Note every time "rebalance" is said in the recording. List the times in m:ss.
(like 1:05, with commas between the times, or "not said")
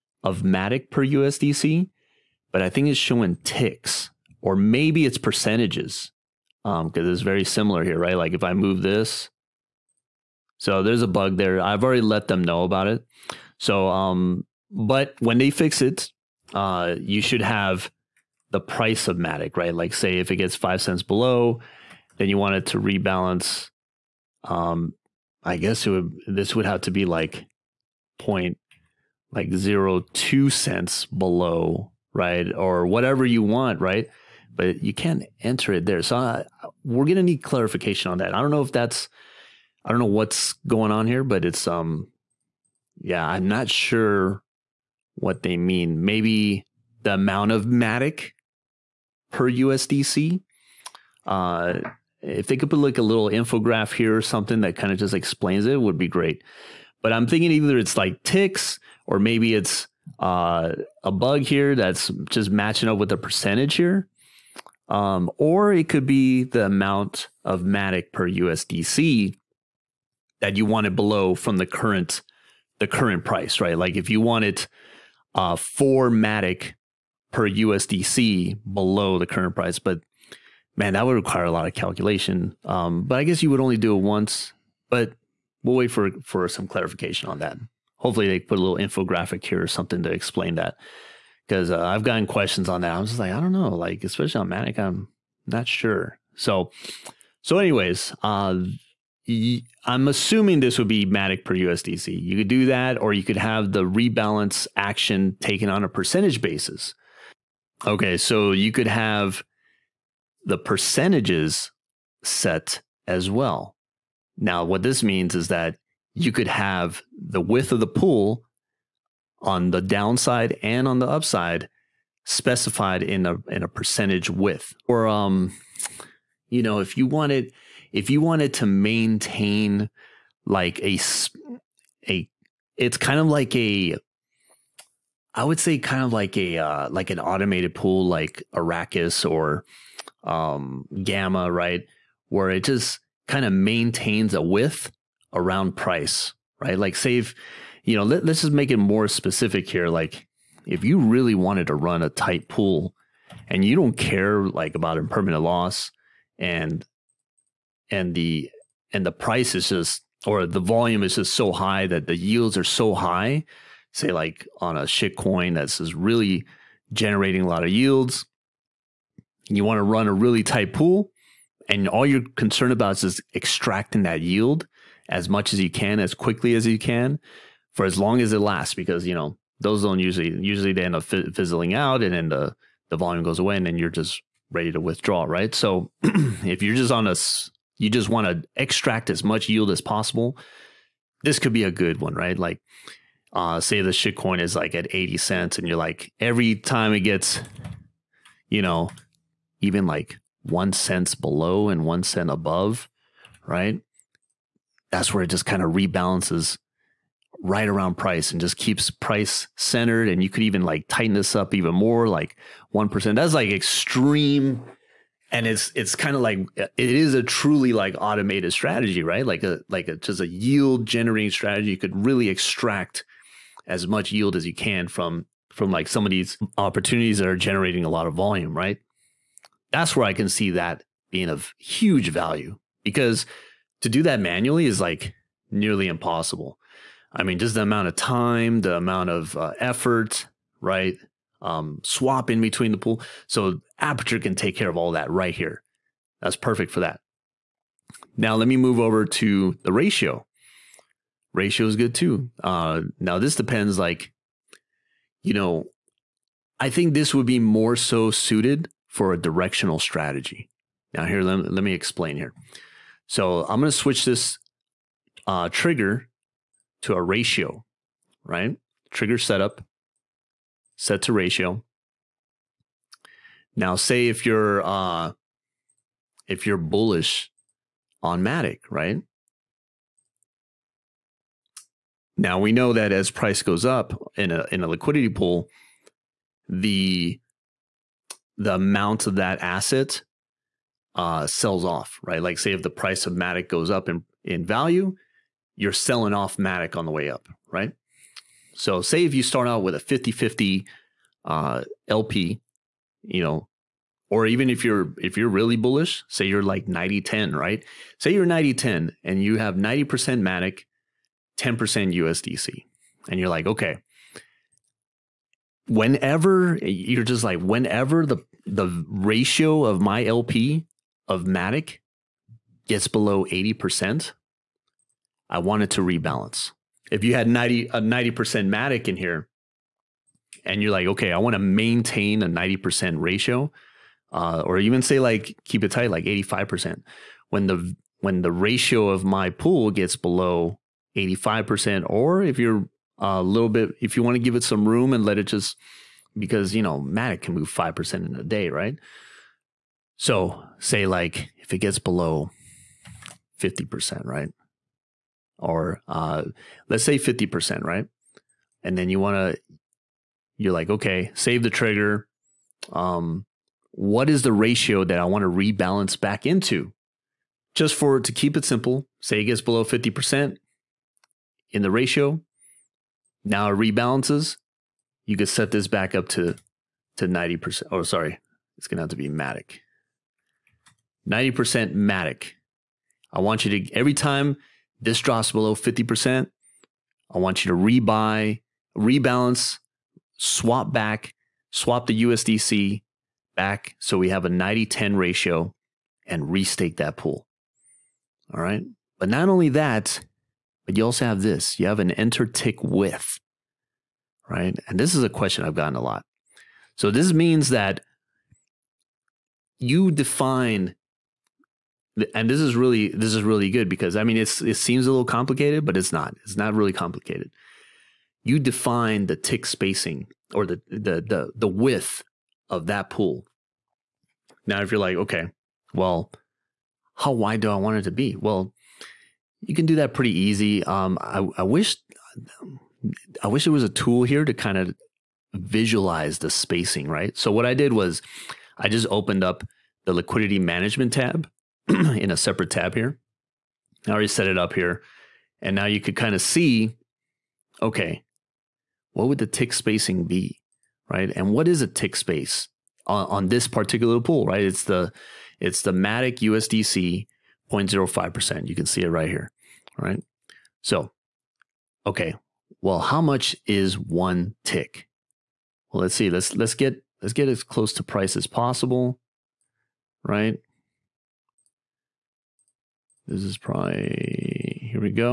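0:22, 1:43, 3:25, 5:25, 6:05, 6:13, 6:28.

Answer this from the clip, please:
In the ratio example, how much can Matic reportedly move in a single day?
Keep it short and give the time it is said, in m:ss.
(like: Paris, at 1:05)
5%, at 5:47.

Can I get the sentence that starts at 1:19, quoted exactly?
But man, that would require a lot of calculation.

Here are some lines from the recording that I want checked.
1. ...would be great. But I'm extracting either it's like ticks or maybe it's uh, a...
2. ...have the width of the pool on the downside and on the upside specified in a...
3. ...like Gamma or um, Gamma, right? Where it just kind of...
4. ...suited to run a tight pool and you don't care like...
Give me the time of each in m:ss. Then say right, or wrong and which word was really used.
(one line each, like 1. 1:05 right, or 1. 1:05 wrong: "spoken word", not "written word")
1. 0:55 wrong: "thinking", not "extracting"
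2. 1:56 right
3. 2:18 wrong: "Arrakis", not "Gamma"
4. 2:31 wrong: "wanted", not "suited".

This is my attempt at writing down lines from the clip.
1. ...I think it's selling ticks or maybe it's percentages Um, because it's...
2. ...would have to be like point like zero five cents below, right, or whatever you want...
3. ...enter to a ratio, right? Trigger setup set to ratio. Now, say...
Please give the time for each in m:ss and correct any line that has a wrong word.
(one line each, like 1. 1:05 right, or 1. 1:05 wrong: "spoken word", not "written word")
1. 0:02 wrong: "showing", not "selling"
2. 0:26 wrong: "two", not "five"
3. 4:25 wrong: "trigger", not "enter".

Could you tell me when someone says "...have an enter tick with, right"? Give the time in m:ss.
6:41.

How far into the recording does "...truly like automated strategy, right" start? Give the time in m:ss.
3:37.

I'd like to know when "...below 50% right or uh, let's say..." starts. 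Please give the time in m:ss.
5:51.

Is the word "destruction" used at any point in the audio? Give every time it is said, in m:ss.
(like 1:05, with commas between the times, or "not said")
not said.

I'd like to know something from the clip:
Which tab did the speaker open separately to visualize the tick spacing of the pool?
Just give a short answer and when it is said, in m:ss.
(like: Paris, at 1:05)
liquidity management, at 7:19.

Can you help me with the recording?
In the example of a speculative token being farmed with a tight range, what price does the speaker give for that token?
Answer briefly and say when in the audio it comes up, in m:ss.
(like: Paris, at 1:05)
80 cents, at 3:14.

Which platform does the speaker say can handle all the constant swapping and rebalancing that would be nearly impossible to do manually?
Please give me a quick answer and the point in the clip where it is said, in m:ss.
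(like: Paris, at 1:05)
Aperture, at 4:03.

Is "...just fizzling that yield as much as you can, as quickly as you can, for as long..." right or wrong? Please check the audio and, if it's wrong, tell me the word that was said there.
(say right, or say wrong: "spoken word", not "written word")
wrong: "extracting", not "fizzling".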